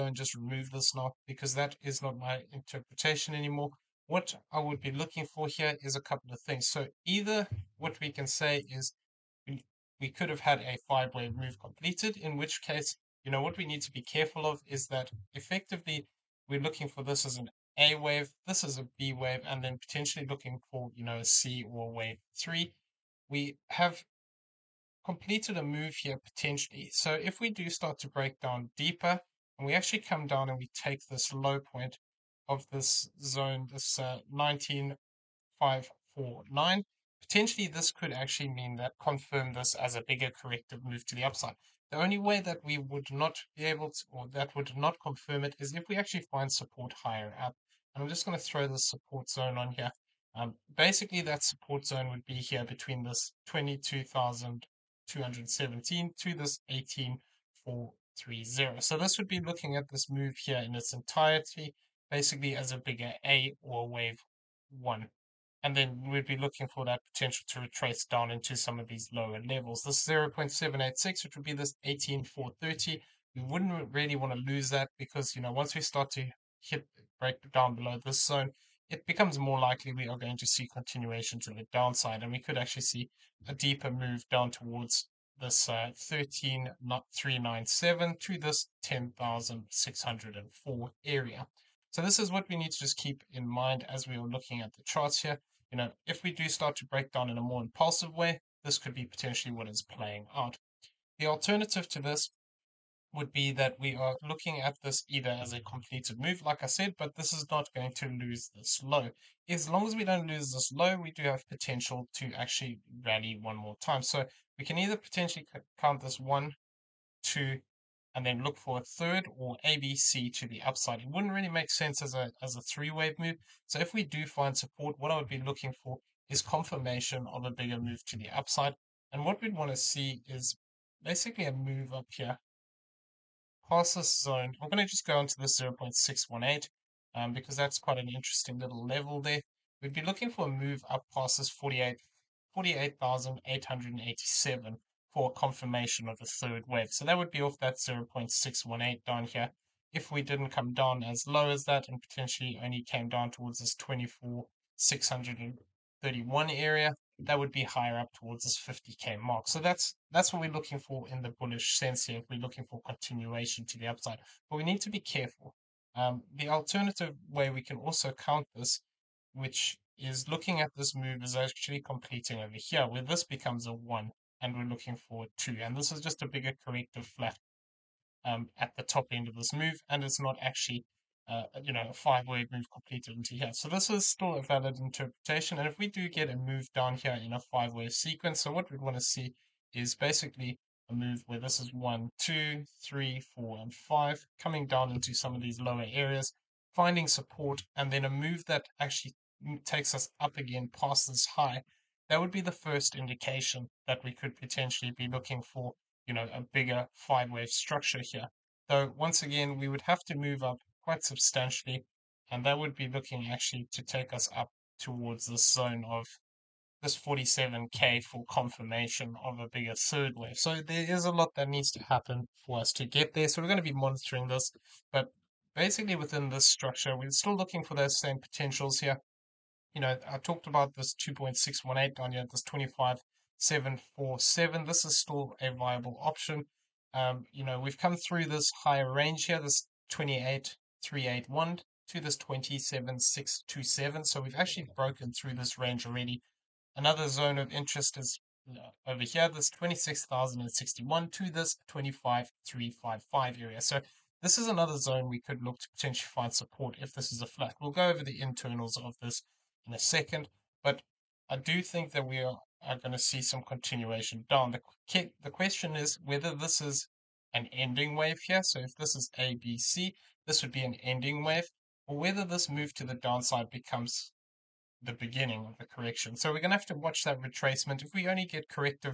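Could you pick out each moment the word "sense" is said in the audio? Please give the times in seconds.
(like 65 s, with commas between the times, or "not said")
121 s, 161 s.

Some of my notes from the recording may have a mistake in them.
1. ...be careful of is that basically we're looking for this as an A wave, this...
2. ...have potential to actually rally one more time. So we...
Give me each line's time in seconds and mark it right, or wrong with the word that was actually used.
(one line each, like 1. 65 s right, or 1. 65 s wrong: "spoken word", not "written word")
1. 13 s wrong: "effectively", not "basically"
2. 111 s right.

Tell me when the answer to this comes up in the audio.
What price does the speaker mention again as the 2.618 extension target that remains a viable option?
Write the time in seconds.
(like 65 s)
232 s.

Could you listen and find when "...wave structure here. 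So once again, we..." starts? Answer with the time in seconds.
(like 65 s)
207 s.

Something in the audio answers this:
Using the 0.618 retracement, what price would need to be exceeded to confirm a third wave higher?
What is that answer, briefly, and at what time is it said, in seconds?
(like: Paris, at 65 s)
48,887, at 142 s.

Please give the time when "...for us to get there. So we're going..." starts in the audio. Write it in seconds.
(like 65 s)
222 s.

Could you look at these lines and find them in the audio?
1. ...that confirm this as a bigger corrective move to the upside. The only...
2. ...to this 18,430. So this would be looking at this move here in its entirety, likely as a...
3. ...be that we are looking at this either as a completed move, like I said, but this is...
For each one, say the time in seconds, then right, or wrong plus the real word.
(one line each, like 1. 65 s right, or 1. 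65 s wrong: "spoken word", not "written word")
1. 38 s right
2. 56 s wrong: "basically", not "likely"
3. 103 s right.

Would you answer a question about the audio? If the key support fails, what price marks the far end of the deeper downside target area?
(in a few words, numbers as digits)
10,604.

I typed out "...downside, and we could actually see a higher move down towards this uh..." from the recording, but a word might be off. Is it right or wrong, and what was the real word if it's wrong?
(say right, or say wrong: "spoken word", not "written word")
wrong: "deeper", not "higher".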